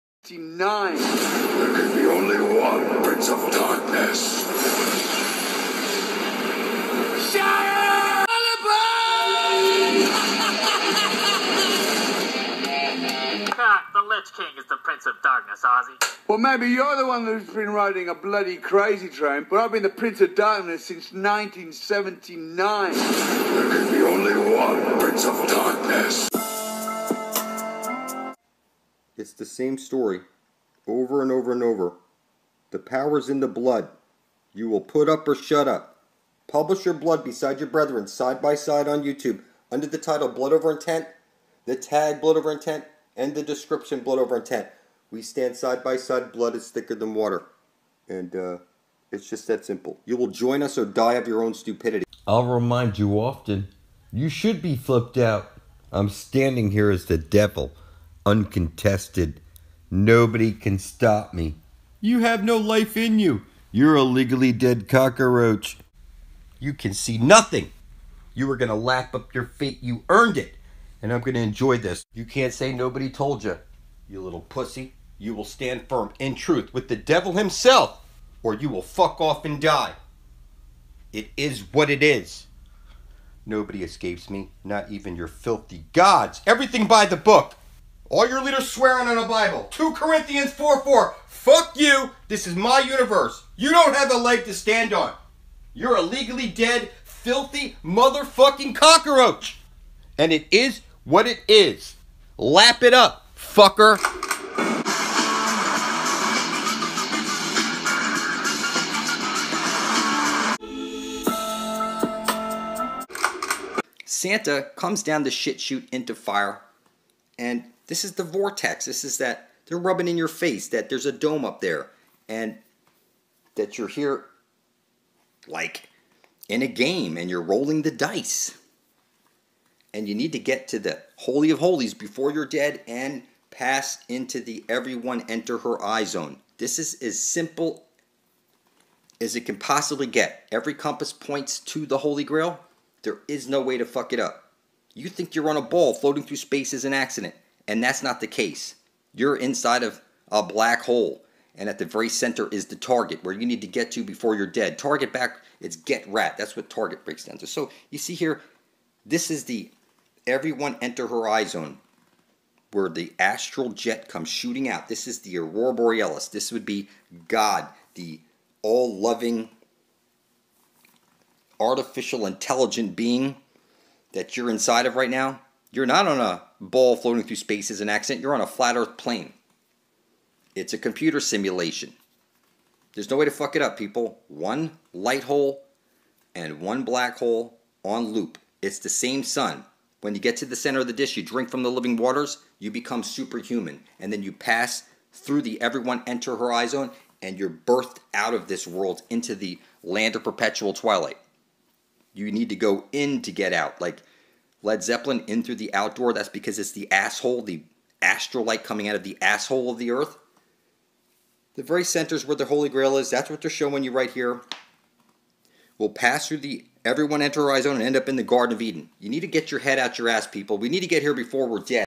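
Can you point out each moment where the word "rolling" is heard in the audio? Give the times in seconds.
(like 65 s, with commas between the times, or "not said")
127 s.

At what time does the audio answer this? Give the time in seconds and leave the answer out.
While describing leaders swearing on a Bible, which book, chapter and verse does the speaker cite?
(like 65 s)
89 s.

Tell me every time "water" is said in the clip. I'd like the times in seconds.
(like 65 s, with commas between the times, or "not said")
47 s, 191 s.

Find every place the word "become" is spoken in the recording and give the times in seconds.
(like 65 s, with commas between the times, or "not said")
192 s.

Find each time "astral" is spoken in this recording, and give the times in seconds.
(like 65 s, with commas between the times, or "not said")
163 s, 208 s.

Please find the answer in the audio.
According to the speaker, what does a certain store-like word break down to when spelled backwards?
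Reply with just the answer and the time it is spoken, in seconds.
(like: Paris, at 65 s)
get rat, at 155 s.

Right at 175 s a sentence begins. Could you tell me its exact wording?
You're not on a ball floating through space as an accident, you're on a flat earth plane.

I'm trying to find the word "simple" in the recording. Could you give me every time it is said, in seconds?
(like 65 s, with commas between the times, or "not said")
49 s, 137 s.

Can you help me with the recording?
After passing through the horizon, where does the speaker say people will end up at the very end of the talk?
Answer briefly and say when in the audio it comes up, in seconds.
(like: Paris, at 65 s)
Garden of Eden, at 218 s.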